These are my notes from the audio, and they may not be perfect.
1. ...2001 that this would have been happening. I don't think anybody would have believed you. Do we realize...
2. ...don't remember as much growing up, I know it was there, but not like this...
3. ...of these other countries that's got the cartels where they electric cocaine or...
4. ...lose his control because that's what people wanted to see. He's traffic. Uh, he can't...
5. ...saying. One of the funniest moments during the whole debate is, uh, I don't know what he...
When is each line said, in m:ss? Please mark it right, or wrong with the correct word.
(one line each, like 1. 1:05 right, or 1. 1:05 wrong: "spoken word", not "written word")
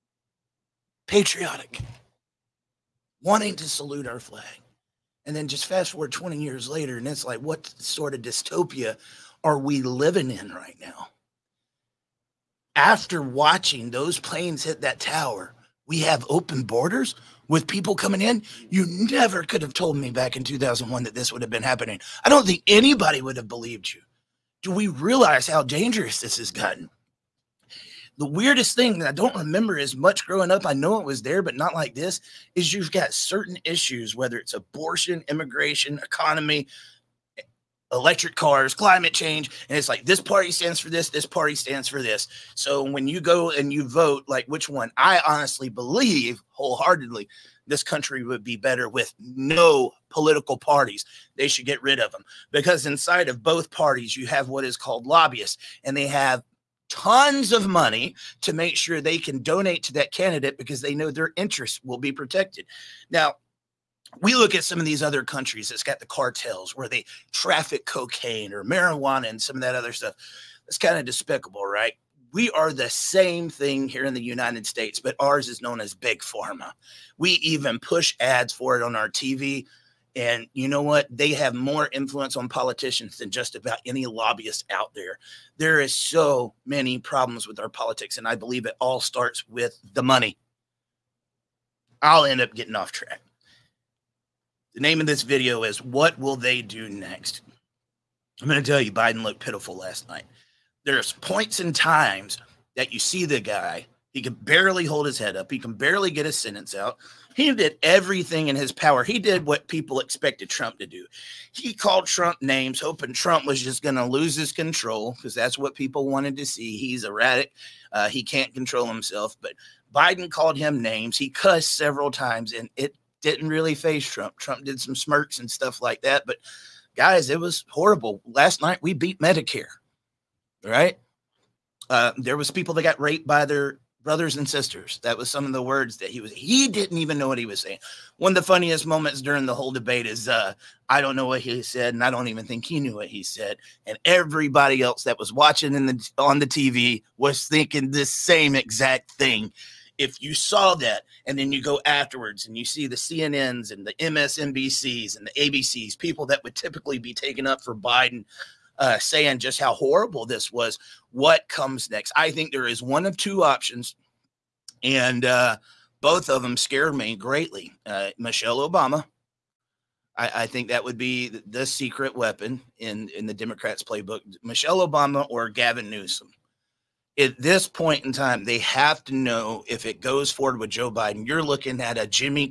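1. 0:20 right
2. 0:29 right
3. 1:04 wrong: "traffic", not "electric"
4. 1:54 wrong: "erratic", not "traffic"
5. 2:17 right.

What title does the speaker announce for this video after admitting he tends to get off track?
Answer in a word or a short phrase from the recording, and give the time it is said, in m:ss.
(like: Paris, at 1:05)
What Will They Do Next?, at 1:35.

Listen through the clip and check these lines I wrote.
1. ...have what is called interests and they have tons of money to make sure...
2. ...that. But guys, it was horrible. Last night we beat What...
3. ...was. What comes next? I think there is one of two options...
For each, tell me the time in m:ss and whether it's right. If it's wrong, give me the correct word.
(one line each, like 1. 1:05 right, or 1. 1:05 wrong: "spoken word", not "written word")
1. 0:54 wrong: "lobbyists", not "interests"
2. 2:06 wrong: "Medicare", not "What"
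3. 2:40 right.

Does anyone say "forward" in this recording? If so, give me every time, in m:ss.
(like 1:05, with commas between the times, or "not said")
0:05, 3:00.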